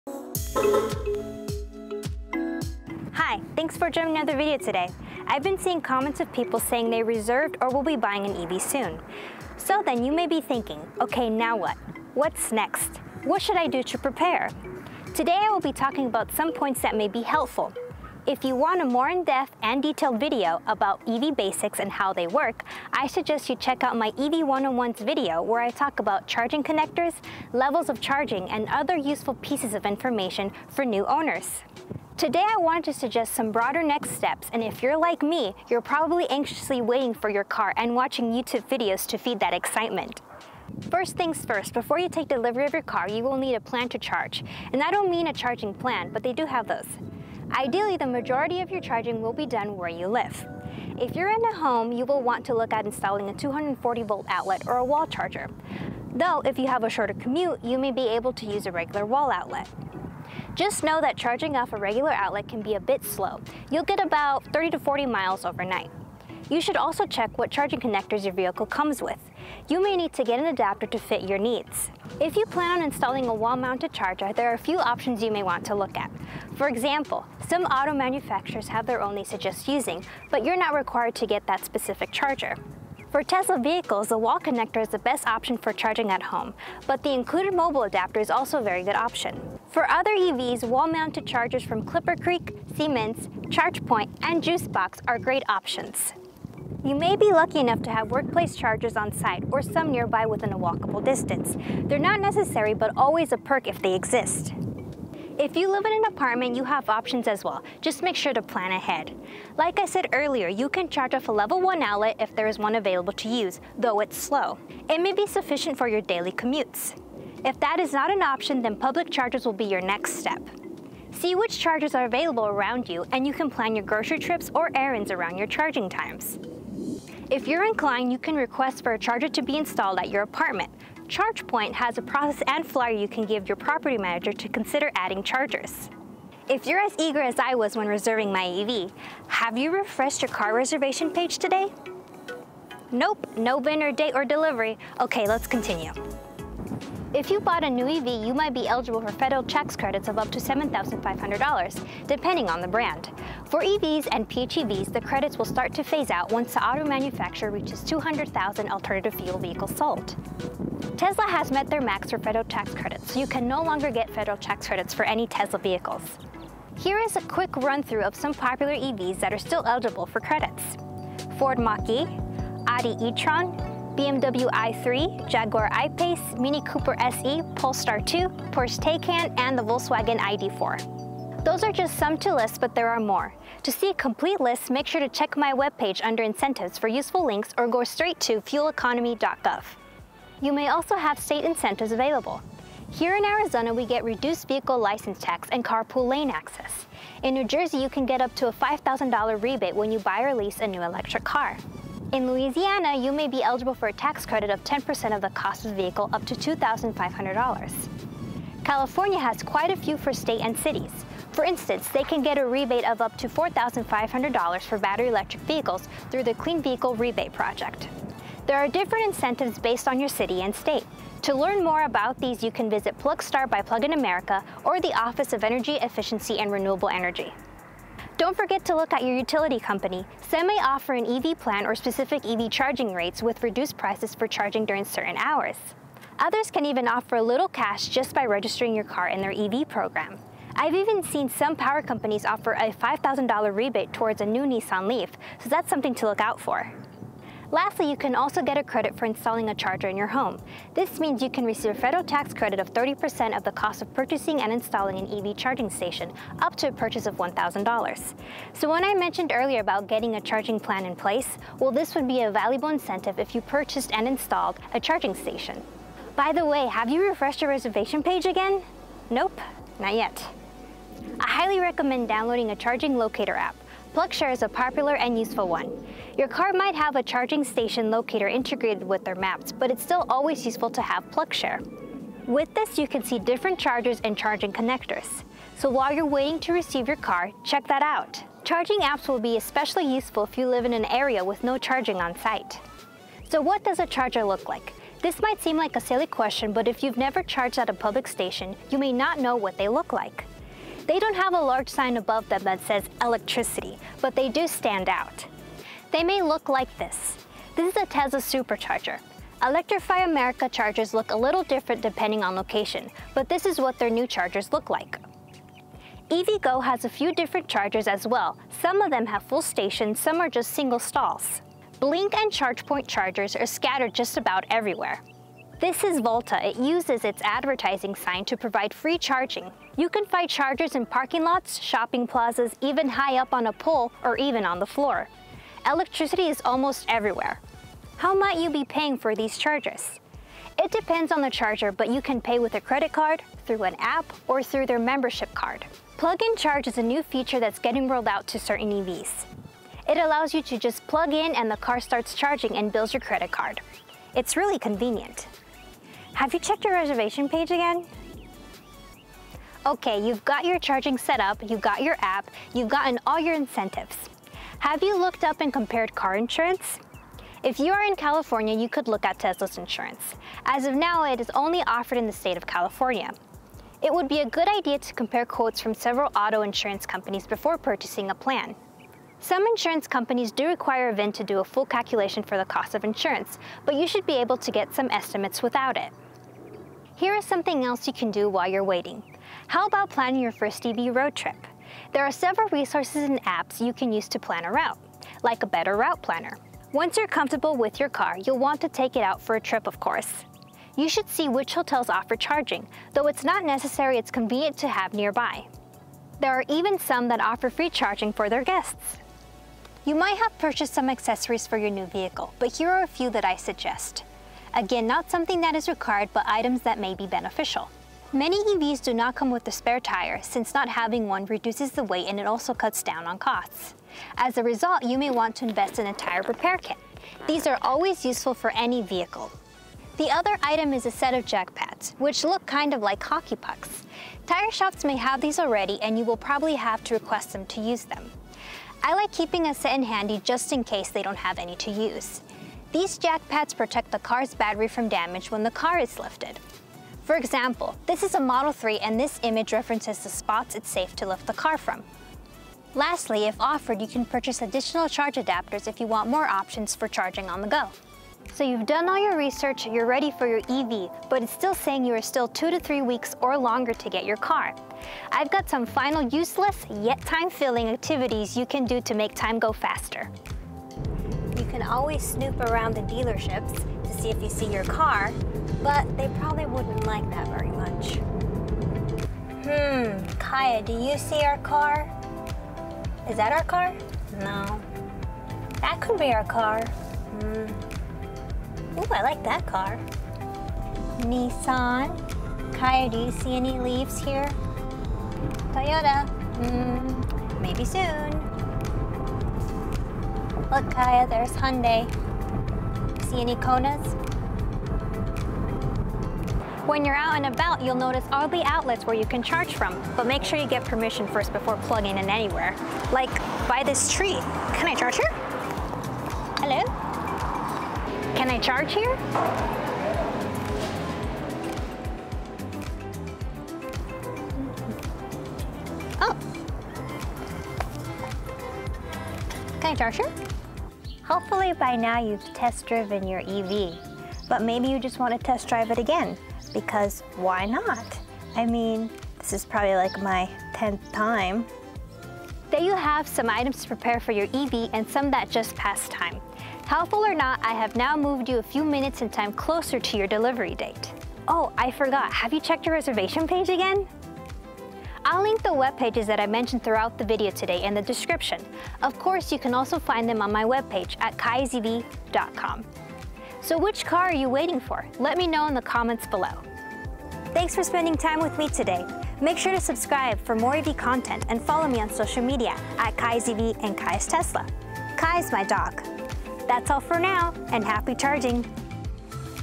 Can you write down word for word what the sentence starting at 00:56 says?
Though, if you have a shorter commute, you may be able to use a regular wall outlet.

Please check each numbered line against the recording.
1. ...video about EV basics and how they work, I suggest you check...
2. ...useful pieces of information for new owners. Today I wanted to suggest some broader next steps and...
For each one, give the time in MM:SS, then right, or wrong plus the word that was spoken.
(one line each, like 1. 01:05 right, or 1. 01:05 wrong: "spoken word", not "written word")
1. 00:20 right
2. 00:28 right.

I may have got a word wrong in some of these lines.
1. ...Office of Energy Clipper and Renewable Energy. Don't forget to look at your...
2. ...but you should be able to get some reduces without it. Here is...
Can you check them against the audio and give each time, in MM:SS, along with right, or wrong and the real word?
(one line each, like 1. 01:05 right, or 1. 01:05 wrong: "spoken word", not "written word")
1. 03:44 wrong: "Efficiency", not "Clipper"
2. 06:23 wrong: "estimates", not "reduces".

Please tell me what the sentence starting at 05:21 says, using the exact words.
Blink and ChargePoint chargers are scattered just about everywhere.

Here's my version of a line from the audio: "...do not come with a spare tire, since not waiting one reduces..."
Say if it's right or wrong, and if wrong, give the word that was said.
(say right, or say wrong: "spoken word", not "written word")
wrong: "having", not "waiting".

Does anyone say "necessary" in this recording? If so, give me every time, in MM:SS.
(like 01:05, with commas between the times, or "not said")
01:42, 06:43.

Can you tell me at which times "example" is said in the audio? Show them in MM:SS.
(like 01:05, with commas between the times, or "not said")
01:16, 07:27.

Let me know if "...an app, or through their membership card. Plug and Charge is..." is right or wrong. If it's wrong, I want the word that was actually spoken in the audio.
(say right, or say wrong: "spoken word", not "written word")
right.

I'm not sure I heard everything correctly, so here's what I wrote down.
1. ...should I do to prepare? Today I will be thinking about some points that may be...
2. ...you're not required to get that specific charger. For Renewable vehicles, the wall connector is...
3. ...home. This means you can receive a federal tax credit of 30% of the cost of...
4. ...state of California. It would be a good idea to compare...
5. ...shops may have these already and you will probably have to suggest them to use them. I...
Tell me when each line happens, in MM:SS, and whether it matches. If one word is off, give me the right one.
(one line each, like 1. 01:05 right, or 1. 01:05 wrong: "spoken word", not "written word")
1. 00:13 wrong: "talking", not "thinking"
2. 01:20 wrong: "Tesla", not "Renewable"
3. 04:10 right
4. 06:12 right
5. 07:14 wrong: "request", not "suggest".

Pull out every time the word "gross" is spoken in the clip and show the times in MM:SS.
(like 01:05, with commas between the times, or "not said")
not said.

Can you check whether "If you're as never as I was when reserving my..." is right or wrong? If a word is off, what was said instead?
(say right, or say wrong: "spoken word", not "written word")
wrong: "eager", not "never".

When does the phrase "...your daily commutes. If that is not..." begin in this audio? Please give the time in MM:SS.
01:55.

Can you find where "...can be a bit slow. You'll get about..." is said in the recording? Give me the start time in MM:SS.
01:02.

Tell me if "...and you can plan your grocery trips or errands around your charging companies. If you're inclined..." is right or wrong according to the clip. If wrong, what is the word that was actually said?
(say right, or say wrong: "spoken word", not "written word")
wrong: "times", not "companies".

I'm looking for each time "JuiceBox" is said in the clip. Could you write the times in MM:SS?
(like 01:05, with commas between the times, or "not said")
01:34.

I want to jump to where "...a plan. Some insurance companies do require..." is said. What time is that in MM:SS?
06:18.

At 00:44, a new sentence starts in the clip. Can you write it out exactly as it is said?
And I don't mean a charging plan, but they do have those.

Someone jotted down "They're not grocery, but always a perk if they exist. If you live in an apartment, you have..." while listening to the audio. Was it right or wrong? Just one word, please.
wrong.